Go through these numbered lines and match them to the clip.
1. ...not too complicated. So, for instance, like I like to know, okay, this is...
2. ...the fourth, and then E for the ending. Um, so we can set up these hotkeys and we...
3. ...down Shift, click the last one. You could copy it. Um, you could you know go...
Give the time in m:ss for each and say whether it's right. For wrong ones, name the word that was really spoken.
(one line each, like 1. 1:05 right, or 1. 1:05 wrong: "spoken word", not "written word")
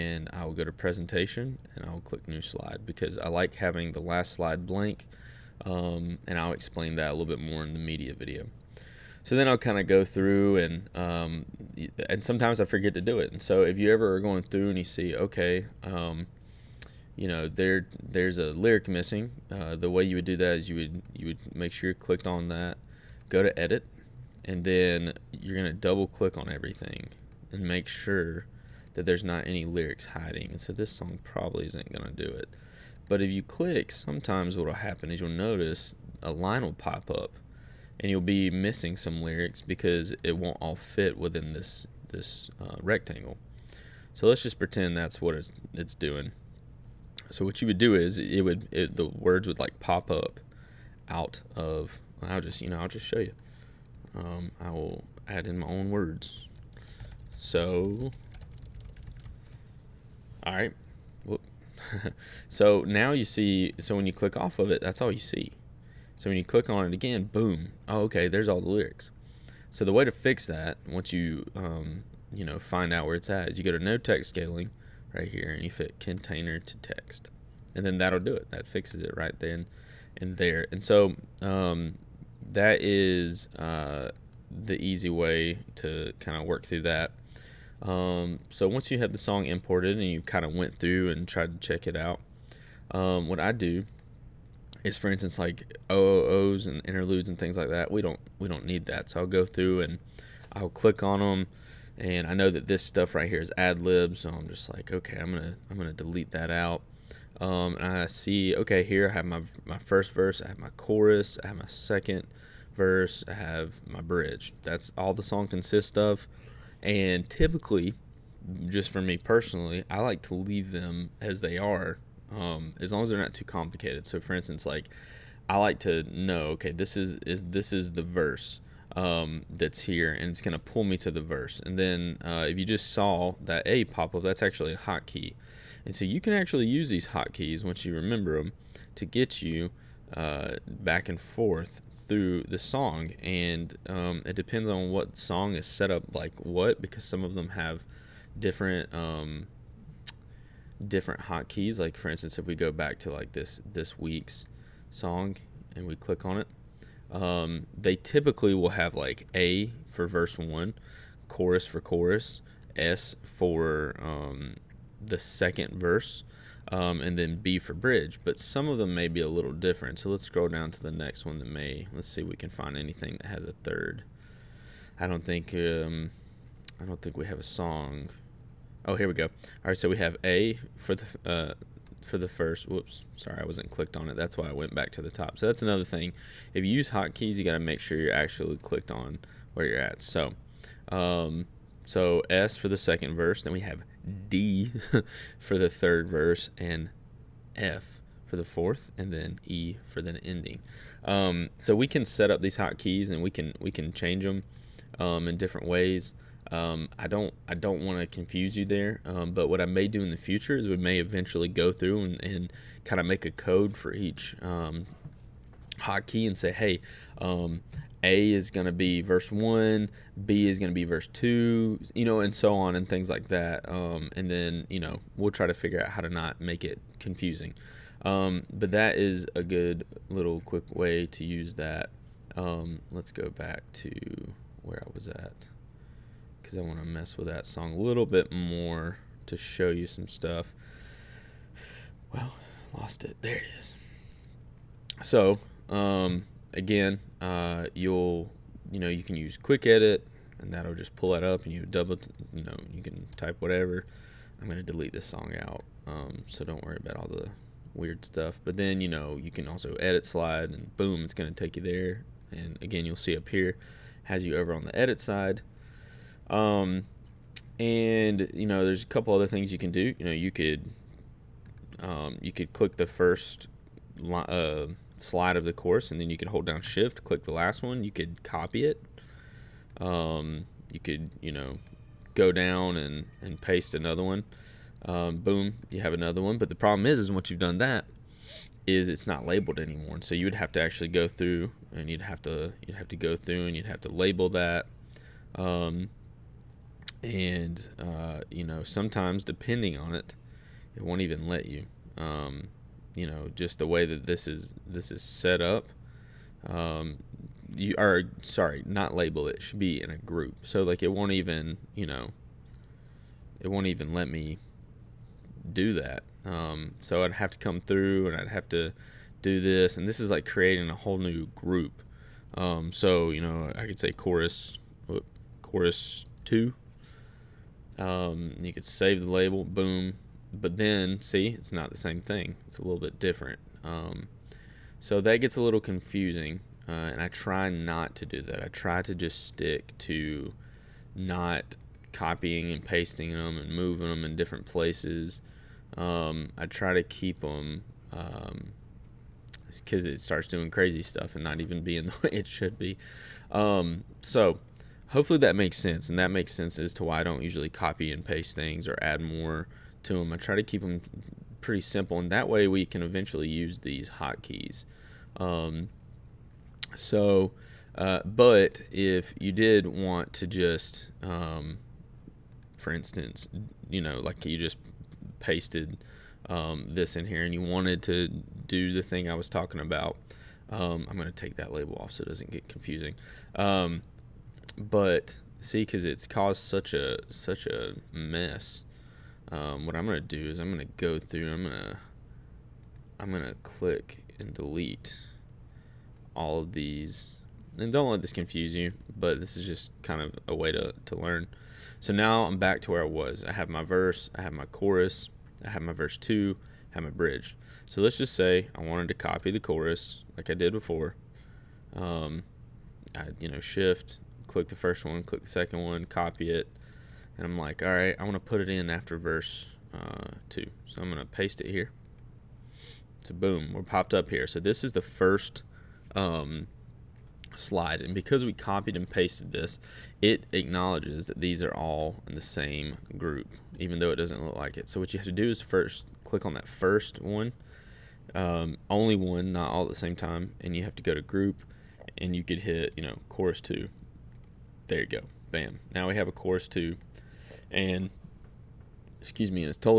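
1. 2:03 right
2. 3:18 right
3. 4:36 right.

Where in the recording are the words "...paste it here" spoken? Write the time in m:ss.
7:01.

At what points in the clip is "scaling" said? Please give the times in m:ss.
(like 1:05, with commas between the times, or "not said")
1:14.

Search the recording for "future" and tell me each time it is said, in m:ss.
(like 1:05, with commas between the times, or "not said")
3:30.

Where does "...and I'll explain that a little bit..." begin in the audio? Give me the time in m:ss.
0:06.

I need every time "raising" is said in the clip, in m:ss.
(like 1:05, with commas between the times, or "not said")
not said.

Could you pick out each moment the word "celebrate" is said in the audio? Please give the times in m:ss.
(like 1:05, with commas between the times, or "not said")
not said.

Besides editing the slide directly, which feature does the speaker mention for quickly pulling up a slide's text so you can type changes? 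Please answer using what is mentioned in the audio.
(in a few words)
Quick edit.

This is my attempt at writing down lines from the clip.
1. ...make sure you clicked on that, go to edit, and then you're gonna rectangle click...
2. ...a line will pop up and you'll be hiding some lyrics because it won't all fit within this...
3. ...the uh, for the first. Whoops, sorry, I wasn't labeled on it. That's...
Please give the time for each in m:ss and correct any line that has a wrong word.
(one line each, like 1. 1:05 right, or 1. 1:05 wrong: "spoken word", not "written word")
1. 0:21 wrong: "double", not "rectangle"
2. 0:36 wrong: "missing", not "hiding"
3. 3:00 wrong: "clicked", not "labeled".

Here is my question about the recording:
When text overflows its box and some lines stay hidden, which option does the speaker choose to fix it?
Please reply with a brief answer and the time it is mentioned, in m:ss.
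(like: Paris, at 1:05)
Fit container to text, at 1:15.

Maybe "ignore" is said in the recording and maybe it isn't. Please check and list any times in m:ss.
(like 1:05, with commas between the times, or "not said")
not said.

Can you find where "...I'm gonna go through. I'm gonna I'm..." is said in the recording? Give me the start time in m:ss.
6:30.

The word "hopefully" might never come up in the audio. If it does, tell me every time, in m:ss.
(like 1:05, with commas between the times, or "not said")
5:54.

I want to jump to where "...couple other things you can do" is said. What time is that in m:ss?
4:28.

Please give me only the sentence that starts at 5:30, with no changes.
But then, see, it's not the same thing.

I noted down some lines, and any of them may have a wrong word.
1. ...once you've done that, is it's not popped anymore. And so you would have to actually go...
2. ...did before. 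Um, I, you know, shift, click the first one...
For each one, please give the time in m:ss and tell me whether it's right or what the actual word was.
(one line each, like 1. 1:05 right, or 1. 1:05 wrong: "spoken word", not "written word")
1. 4:47 wrong: "labeled", not "popped"
2. 6:50 right.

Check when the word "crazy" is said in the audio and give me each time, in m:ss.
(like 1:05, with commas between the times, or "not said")
5:50.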